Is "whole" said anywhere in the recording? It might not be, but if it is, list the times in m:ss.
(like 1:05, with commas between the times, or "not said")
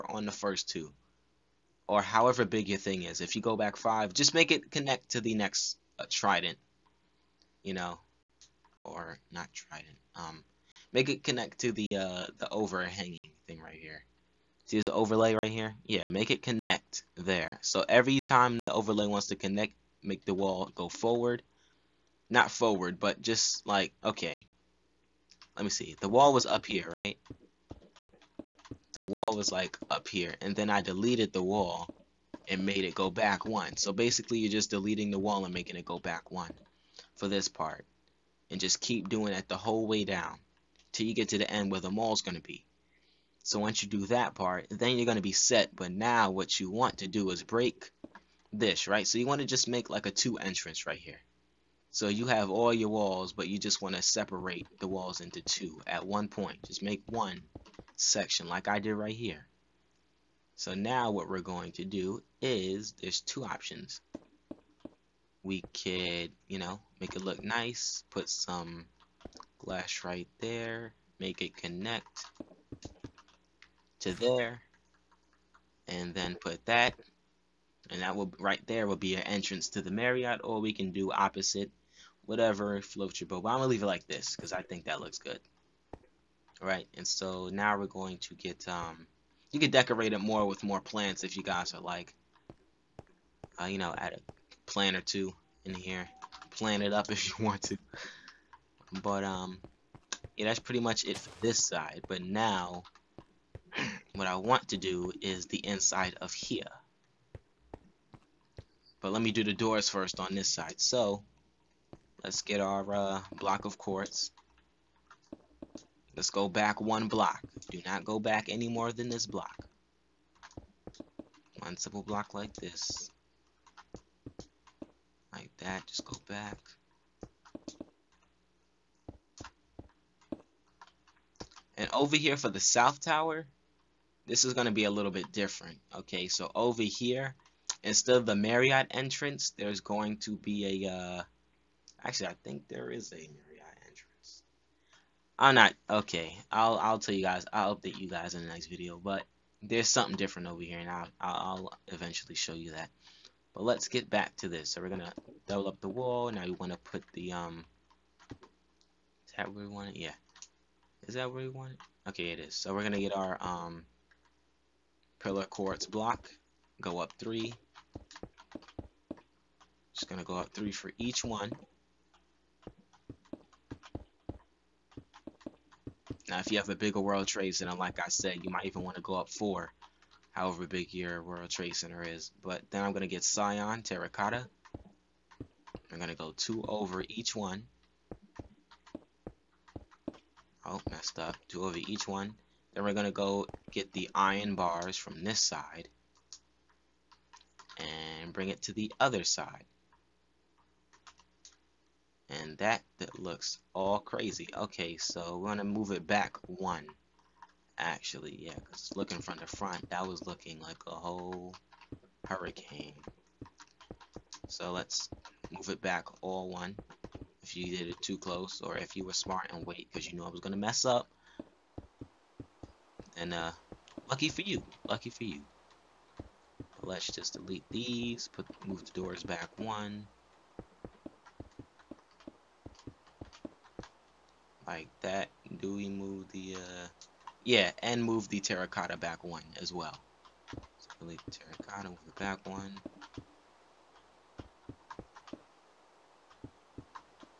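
0:39, 3:30.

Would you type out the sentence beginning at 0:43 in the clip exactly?
So once you do that part, then you're going to be set.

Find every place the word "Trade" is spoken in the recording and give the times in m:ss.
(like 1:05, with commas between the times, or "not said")
2:57, 3:01.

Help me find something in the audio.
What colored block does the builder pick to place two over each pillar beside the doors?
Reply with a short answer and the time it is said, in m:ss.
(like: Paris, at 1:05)
Cyan Terracotta, at 3:03.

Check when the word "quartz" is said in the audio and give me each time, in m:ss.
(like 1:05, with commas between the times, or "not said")
1:53, 2:45.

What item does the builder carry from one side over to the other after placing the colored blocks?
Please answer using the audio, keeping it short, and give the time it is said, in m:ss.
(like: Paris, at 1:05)
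Iron bars, at 3:14.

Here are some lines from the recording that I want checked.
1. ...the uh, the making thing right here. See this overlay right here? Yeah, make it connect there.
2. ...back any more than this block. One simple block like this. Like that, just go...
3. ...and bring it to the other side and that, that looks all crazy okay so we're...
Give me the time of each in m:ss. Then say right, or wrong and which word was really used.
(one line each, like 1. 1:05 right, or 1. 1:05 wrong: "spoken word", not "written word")
1. 0:11 wrong: "overhanging", not "making"
2. 1:58 right
3. 3:17 right.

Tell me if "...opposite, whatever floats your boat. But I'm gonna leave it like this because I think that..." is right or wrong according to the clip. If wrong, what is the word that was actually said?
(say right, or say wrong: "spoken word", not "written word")
right.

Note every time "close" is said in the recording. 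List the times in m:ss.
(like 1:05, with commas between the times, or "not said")
3:38.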